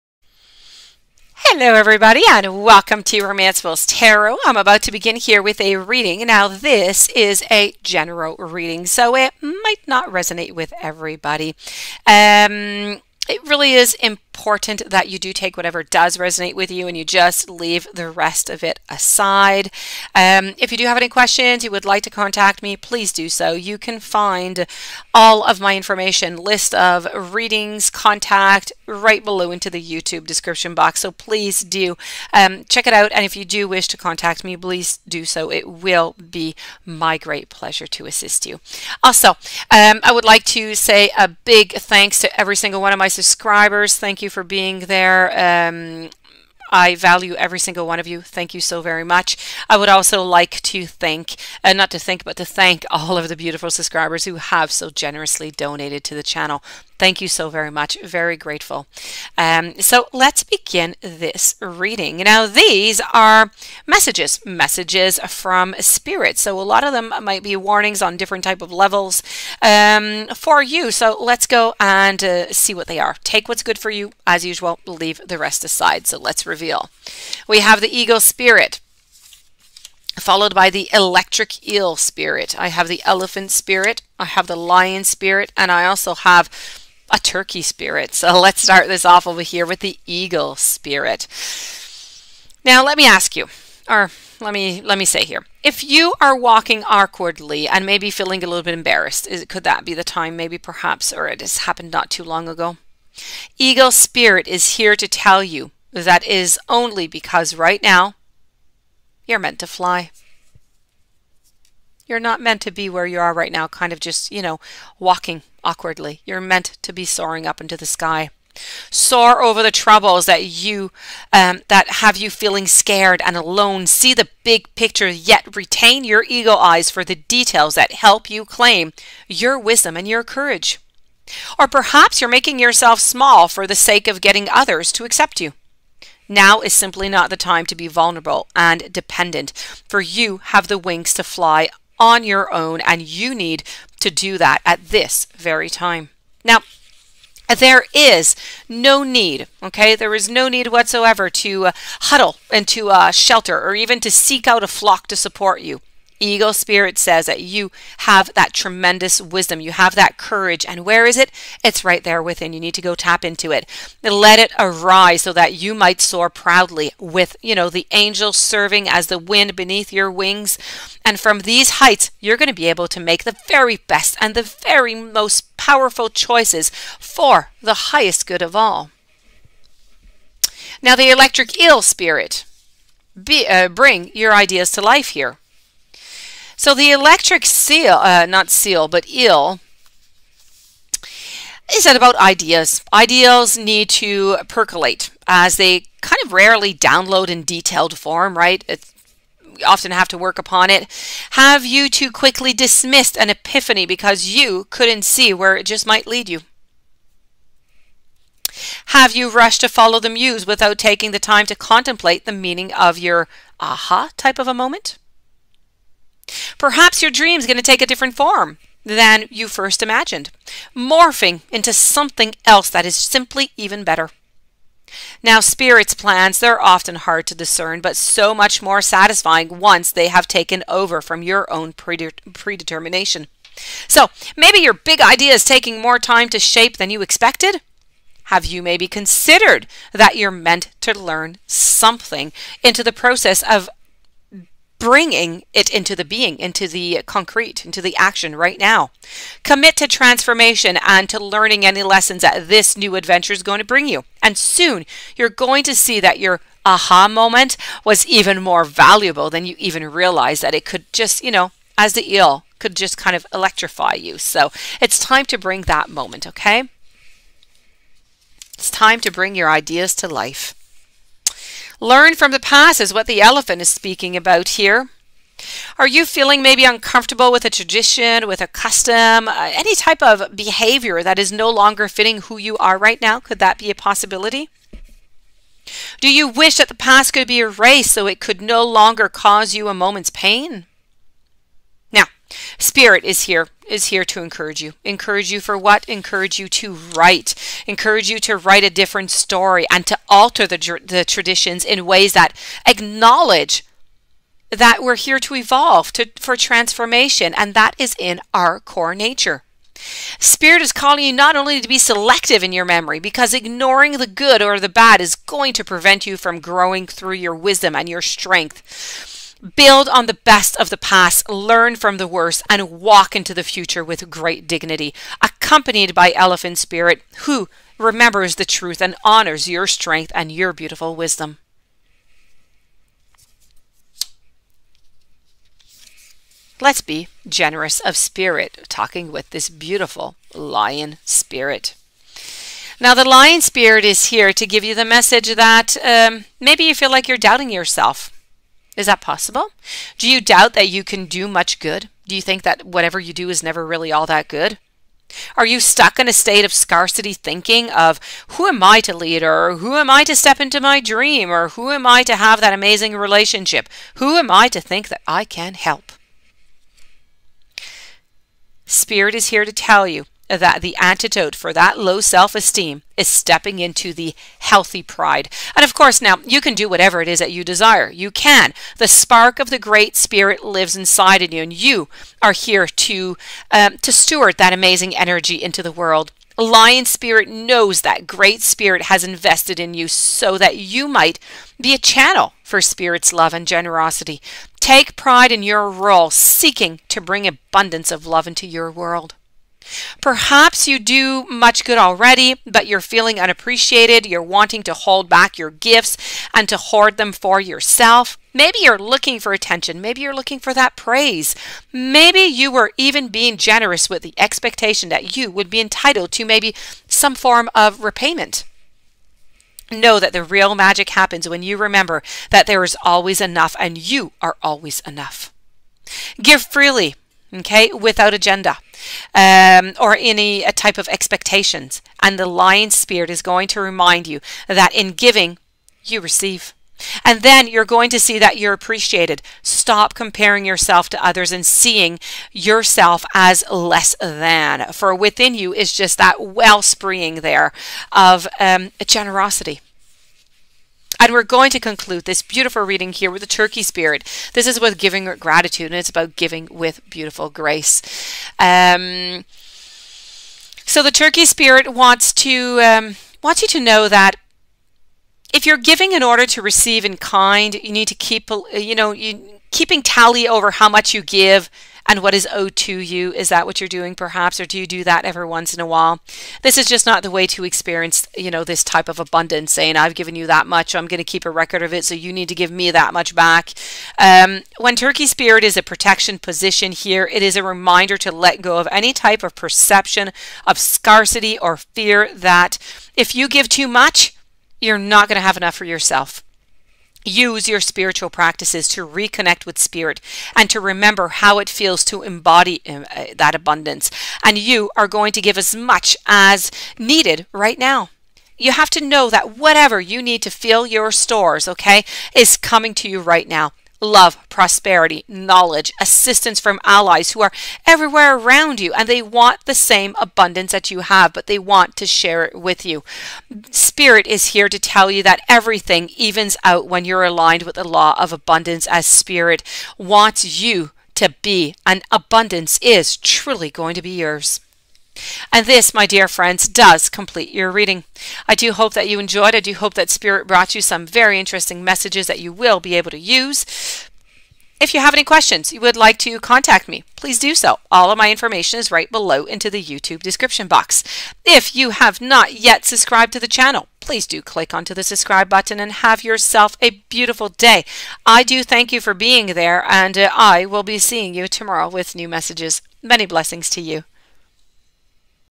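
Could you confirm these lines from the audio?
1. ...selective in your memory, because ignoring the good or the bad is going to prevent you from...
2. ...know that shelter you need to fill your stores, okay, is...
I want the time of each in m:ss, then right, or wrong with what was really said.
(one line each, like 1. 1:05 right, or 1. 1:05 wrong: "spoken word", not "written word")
1. 5:11 right
2. 8:28 wrong: "whatever", not "shelter".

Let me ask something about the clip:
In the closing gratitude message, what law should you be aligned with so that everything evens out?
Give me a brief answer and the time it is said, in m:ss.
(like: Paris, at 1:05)
Law of abundance, at 8:47.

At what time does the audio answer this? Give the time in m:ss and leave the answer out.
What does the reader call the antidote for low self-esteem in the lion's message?
6:14.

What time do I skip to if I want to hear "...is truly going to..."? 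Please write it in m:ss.
8:52.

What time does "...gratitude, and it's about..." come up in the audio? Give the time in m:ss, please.
7:35.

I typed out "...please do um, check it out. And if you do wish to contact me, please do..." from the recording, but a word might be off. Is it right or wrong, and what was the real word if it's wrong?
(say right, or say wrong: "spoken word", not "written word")
right.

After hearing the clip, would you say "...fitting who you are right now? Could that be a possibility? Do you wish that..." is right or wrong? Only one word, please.
right.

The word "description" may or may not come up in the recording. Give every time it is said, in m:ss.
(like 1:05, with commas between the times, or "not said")
0:30, 9:10.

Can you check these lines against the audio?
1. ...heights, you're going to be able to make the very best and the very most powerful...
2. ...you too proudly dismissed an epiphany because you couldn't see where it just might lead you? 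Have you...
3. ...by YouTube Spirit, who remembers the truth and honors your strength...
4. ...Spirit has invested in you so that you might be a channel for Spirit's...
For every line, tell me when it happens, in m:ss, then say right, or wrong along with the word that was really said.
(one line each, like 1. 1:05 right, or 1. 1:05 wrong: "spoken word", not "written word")
1. 2:51 right
2. 3:21 wrong: "quickly", not "proudly"
3. 5:25 wrong: "Elephant", not "YouTube"
4. 6:28 right.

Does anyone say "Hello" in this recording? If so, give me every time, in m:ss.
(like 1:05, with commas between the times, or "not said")
0:01.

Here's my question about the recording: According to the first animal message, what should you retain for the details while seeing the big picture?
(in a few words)
Eagle eyes.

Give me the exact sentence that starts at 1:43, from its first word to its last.
Eagle spirit is here to tell you that is only because right now you're meant to fly.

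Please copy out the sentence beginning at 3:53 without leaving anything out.
So, maybe your big idea is taking more time to shape than you expected.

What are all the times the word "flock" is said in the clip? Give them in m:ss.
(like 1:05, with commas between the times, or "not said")
2:34.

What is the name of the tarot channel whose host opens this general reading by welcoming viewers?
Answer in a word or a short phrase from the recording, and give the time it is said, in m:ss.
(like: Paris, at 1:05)
Romancefull's Tarot, at 0:03.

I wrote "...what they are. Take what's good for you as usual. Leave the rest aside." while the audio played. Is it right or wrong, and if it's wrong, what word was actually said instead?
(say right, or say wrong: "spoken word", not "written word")
right.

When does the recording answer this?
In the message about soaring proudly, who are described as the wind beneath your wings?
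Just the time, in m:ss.
2:47.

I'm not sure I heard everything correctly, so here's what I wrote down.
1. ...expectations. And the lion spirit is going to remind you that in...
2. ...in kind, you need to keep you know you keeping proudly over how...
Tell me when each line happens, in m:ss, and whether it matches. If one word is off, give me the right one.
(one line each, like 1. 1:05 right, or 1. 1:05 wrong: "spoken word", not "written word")
1. 7:10 right
2. 7:46 wrong: "tally", not "proudly".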